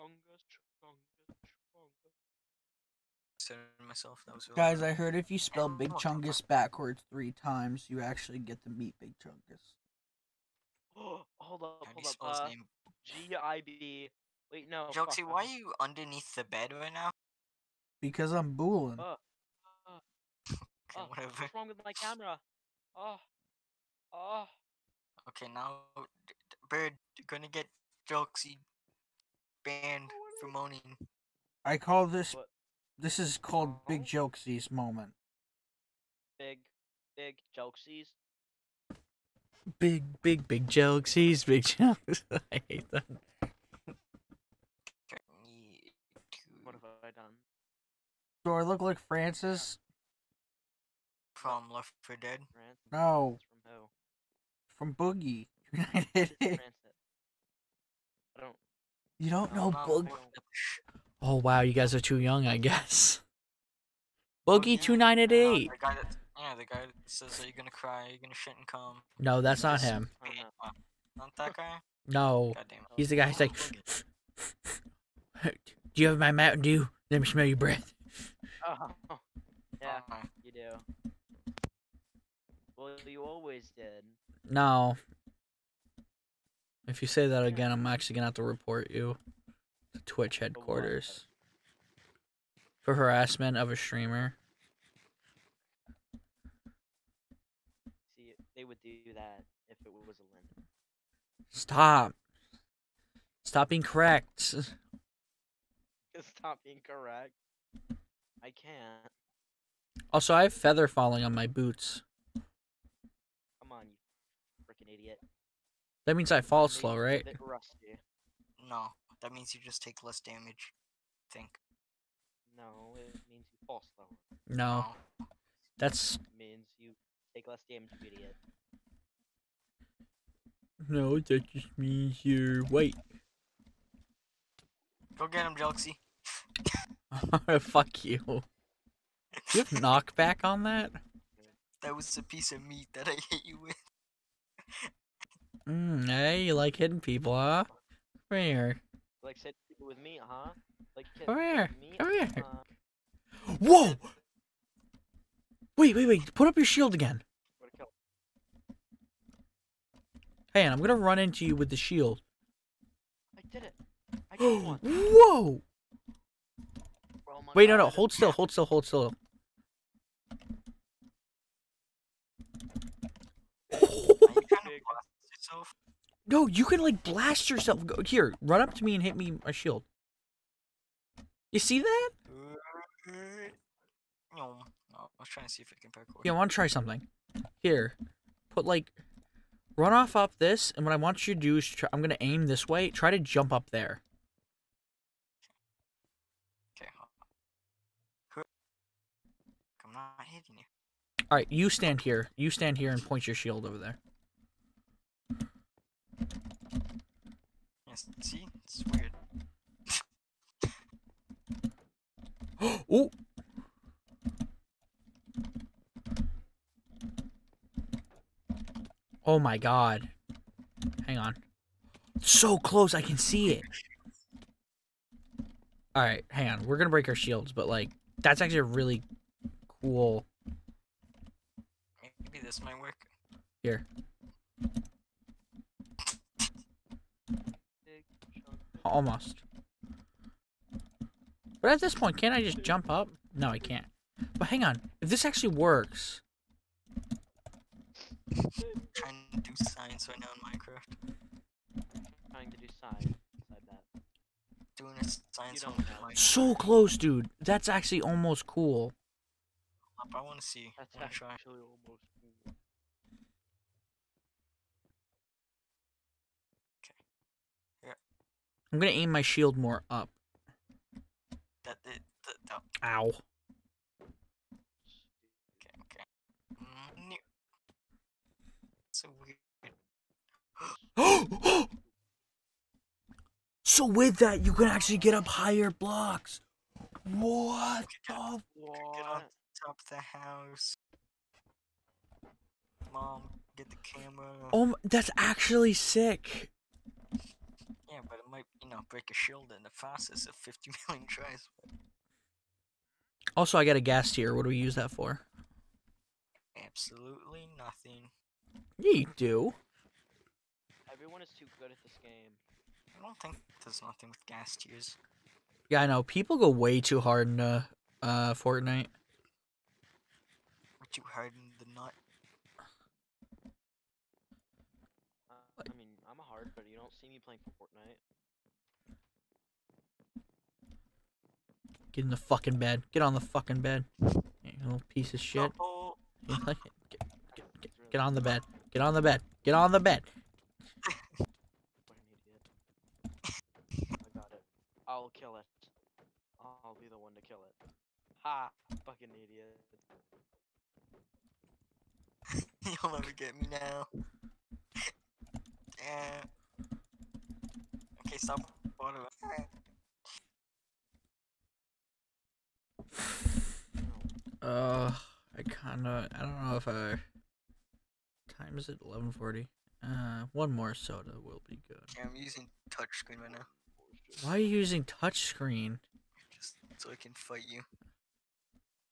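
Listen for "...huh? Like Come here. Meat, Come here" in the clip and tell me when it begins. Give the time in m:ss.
2:30.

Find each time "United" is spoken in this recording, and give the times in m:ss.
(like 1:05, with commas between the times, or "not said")
0:55.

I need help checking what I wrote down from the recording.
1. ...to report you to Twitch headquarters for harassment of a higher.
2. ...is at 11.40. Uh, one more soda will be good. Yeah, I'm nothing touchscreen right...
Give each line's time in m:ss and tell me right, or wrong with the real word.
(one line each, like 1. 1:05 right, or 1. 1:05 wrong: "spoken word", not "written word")
1. 1:28 wrong: "streamer", not "higher"
2. 6:08 wrong: "using", not "nothing".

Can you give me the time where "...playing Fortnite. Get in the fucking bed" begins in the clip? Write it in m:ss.
5:27.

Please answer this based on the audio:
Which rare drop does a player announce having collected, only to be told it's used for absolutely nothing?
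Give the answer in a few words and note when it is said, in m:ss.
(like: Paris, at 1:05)
Ghast tear, at 5:03.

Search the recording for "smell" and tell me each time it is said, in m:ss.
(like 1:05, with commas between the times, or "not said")
1:17.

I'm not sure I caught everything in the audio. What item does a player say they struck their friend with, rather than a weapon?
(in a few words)
A piece of meat.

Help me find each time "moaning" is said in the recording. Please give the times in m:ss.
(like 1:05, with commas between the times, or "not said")
0:30.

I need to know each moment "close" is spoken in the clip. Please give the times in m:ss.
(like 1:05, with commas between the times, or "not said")
3:42, 4:16.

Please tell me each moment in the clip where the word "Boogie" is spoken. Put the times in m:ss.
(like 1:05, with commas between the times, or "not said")
0:54, 0:59, 1:04.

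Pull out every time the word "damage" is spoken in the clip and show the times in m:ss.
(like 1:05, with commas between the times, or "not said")
2:00, 2:07.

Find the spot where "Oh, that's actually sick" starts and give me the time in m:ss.
4:54.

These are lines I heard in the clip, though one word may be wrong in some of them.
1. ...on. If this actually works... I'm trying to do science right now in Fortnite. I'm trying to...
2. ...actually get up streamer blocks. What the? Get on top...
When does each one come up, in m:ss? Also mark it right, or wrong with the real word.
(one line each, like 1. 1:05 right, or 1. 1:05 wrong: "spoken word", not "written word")
1. 4:04 wrong: "Minecraft", not "Fortnite"
2. 4:44 wrong: "higher", not "streamer".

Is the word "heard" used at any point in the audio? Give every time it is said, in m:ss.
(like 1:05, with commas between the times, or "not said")
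0:04.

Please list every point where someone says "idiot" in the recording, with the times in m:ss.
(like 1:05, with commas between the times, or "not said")
1:54, 2:08, 5:49.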